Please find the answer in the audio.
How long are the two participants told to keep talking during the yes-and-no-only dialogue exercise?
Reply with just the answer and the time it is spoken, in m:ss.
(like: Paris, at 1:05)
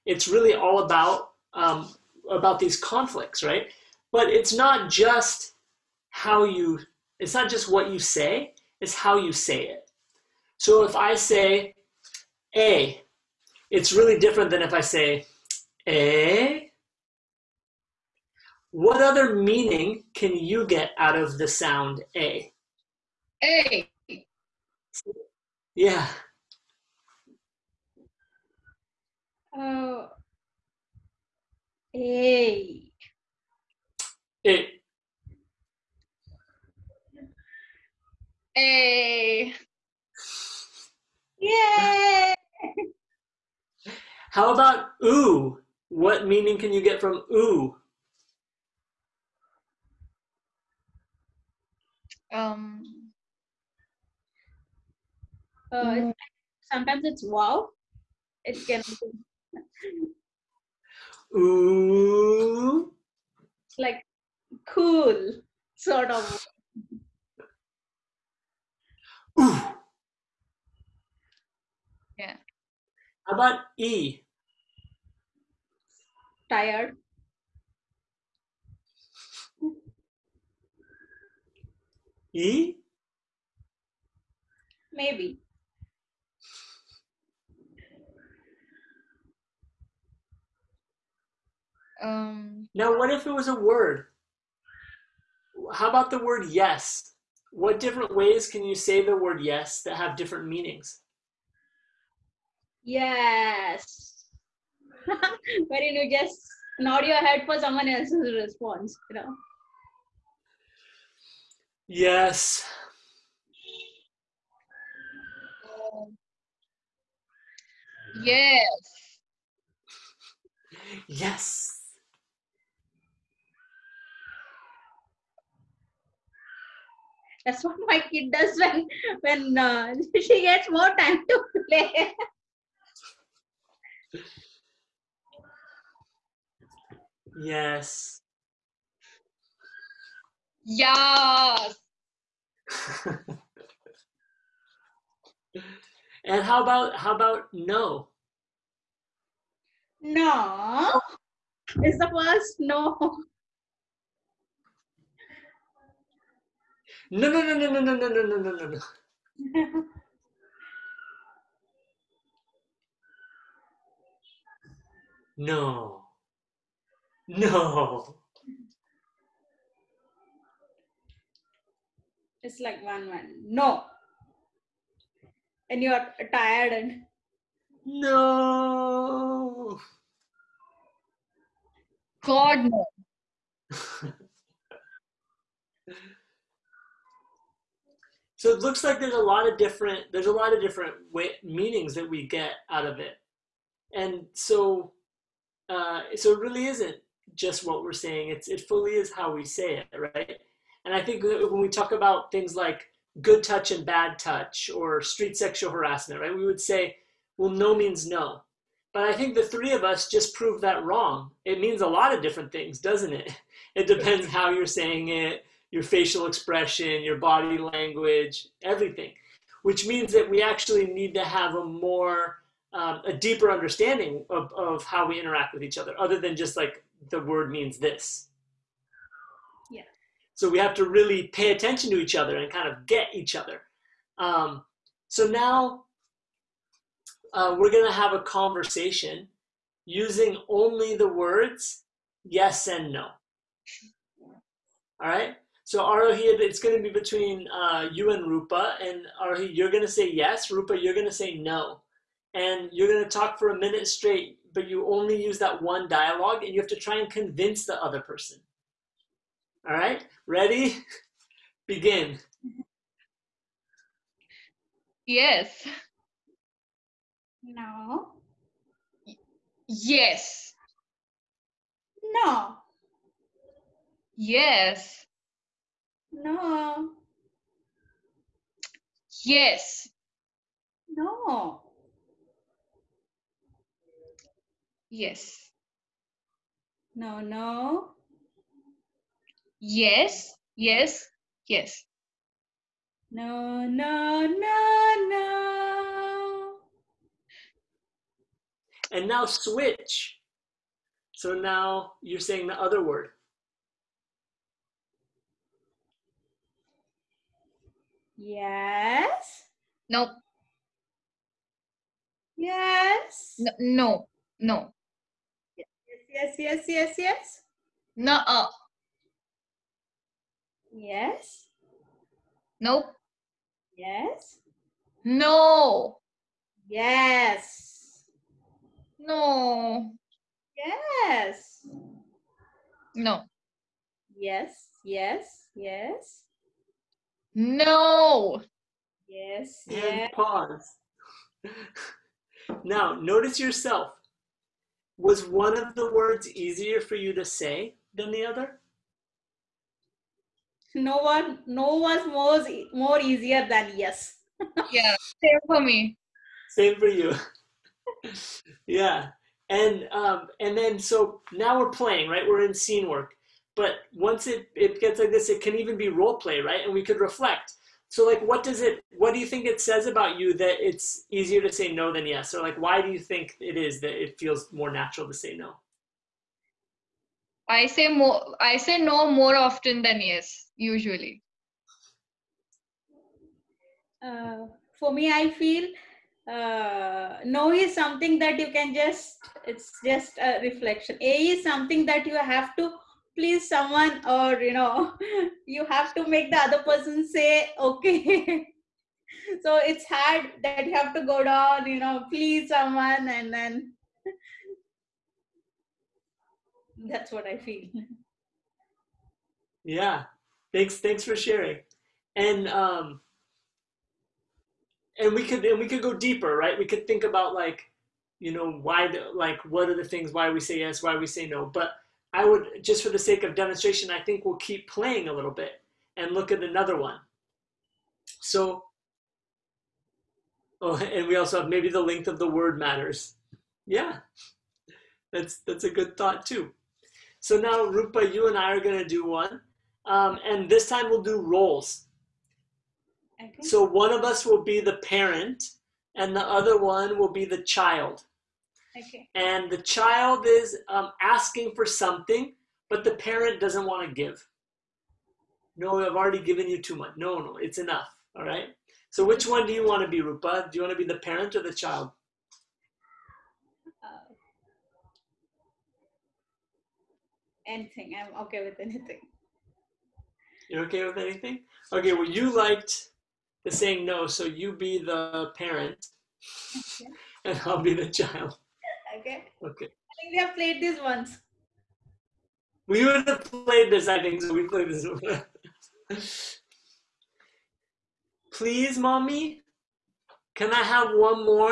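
a minute, at 4:13.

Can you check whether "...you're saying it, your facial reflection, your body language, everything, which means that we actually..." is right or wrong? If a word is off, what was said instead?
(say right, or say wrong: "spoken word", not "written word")
wrong: "expression", not "reflection".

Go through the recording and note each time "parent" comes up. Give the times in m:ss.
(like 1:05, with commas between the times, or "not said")
7:24, 7:32, 7:40, 7:55.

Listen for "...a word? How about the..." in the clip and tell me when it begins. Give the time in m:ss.
1:33.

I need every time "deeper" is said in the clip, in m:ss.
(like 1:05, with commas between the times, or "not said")
3:43, 6:55.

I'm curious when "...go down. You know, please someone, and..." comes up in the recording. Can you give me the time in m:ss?
6:41.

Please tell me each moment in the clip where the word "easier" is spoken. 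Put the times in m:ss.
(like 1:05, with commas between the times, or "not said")
5:46, 5:52, 6:11.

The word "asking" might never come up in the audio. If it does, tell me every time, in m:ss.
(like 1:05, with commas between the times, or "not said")
7:31.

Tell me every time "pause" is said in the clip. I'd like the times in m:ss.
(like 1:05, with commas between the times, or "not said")
5:40.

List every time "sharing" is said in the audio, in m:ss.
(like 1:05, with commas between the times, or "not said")
6:51.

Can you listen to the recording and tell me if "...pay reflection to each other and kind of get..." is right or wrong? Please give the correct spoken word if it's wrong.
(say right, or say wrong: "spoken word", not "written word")
wrong: "attention", not "reflection".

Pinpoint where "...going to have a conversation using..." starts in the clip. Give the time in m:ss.
3:57.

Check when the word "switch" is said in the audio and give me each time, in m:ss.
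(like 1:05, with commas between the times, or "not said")
4:59.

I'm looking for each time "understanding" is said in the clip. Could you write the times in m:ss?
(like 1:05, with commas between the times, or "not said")
3:43.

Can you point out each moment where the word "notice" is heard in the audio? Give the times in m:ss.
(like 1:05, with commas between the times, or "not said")
5:42.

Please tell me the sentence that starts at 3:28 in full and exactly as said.
But I think the three of us just proved that wrong.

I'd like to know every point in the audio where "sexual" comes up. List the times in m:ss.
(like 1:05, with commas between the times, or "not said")
3:25.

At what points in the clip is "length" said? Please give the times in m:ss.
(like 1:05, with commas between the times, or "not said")
7:11.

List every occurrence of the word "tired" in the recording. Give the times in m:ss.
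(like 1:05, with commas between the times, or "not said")
1:16, 2:56.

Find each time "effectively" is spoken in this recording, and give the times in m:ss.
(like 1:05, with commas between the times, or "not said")
not said.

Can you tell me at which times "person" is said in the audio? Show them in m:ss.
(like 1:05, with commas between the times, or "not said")
4:18, 6:36.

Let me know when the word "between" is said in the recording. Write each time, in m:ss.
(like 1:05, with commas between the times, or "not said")
4:06.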